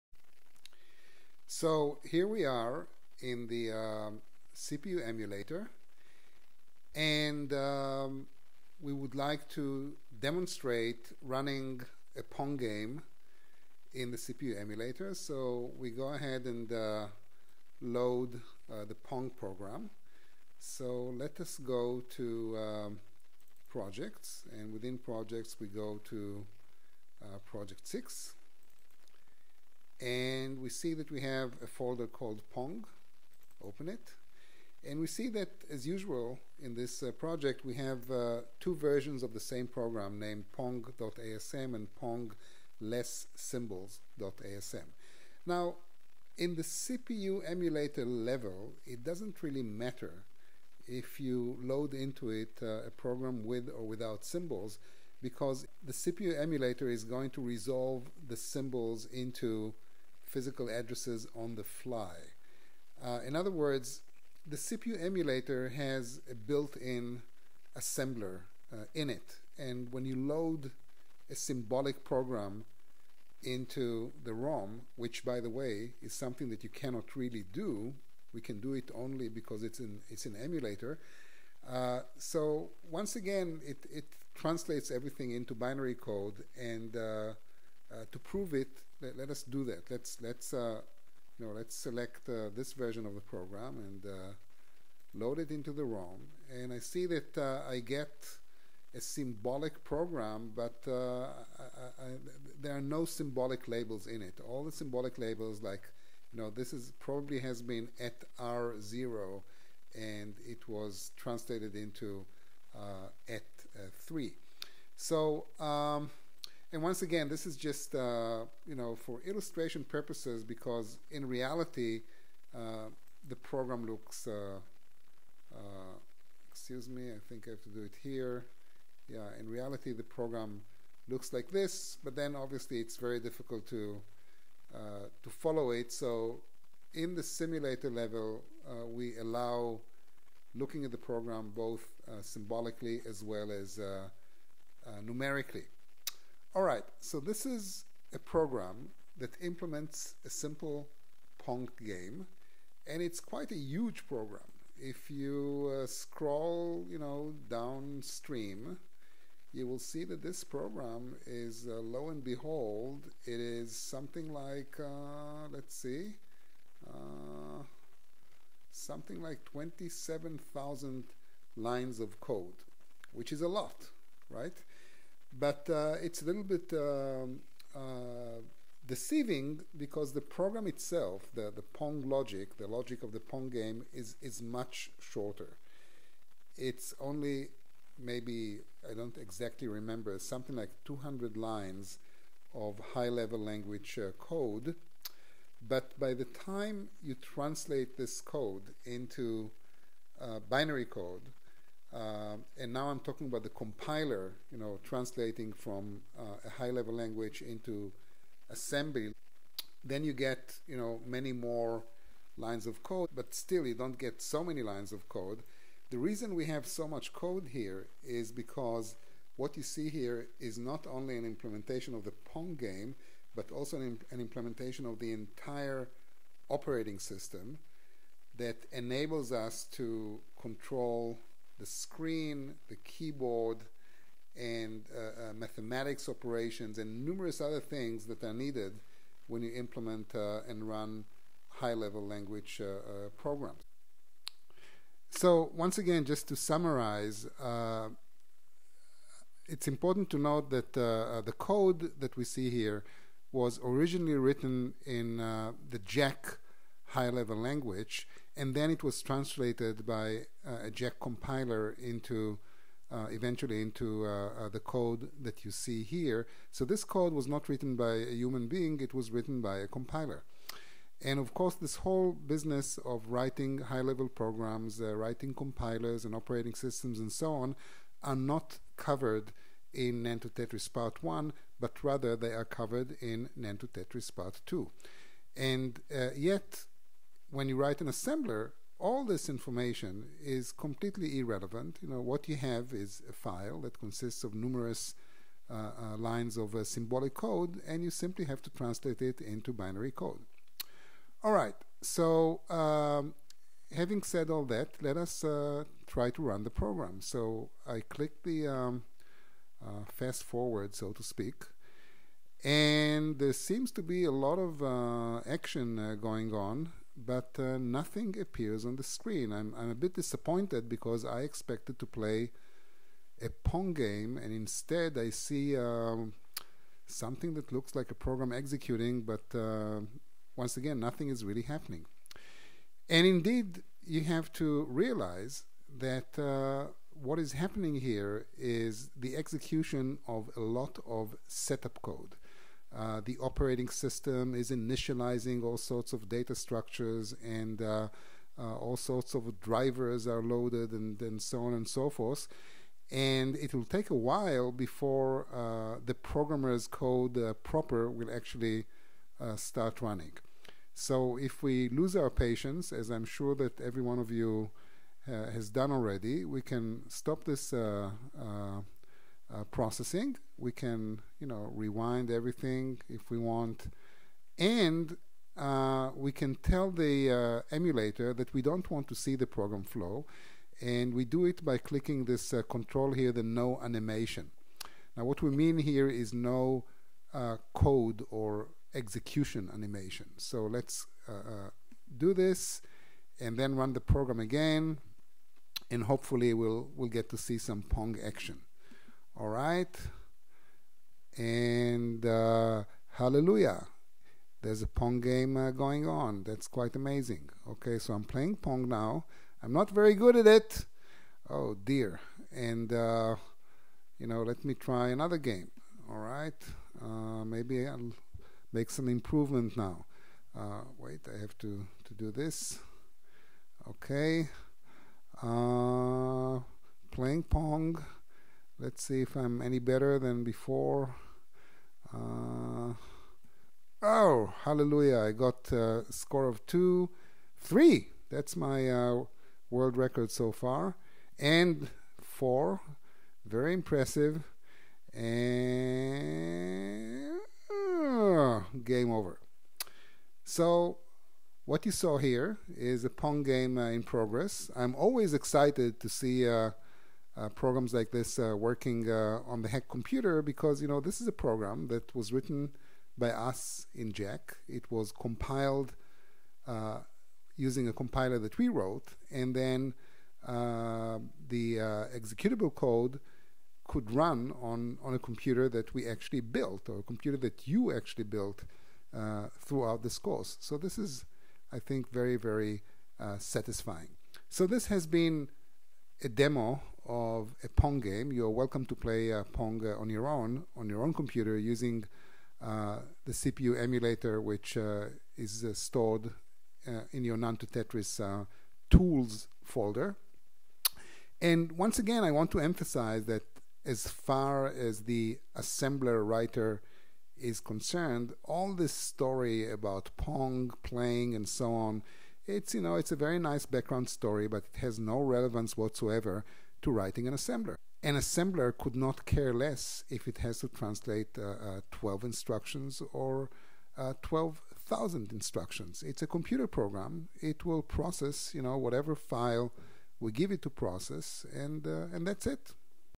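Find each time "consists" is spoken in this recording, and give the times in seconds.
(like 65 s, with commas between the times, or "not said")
293 s.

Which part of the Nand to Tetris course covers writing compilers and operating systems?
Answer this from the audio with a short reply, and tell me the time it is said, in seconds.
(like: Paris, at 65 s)
Part 2, at 283 s.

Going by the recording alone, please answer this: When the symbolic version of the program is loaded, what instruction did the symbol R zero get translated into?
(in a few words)
@3.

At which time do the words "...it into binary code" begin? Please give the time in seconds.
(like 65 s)
299 s.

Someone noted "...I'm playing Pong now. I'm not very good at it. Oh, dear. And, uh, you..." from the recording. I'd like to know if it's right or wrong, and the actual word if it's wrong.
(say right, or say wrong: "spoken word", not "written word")
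right.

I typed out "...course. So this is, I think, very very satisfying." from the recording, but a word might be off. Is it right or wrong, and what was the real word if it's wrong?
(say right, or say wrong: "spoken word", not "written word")
right.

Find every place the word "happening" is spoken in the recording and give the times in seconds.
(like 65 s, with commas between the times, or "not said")
331 s, 337 s.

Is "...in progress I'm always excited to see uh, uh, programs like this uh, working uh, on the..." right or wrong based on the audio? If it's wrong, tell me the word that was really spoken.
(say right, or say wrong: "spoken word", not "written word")
right.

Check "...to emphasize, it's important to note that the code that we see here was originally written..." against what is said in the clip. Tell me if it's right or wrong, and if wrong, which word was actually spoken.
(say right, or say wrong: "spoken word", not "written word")
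wrong: "summarize", not "emphasize".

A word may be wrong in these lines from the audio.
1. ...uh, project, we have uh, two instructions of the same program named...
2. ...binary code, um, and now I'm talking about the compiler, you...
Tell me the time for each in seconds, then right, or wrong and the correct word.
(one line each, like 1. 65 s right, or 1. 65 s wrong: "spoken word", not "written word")
1. 37 s wrong: "versions", not "instructions"
2. 200 s right.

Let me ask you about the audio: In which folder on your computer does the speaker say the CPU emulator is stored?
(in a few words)
Nand to Tetris tools.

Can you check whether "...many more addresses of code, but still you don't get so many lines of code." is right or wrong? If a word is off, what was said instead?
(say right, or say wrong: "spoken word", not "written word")
wrong: "lines", not "addresses".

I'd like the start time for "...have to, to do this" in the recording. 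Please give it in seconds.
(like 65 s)
421 s.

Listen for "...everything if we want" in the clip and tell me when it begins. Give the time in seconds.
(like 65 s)
372 s.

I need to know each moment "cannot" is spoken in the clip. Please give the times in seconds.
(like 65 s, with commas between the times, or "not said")
76 s.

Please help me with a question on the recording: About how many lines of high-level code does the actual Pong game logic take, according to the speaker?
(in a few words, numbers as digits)
200.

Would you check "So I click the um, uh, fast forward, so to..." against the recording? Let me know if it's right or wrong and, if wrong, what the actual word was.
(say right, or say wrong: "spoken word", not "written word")
right.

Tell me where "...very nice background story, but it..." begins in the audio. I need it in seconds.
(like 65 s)
512 s.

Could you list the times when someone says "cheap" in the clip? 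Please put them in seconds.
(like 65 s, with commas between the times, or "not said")
not said.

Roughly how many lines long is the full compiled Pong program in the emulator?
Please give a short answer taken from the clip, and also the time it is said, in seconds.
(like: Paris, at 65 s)
27,000, at 169 s.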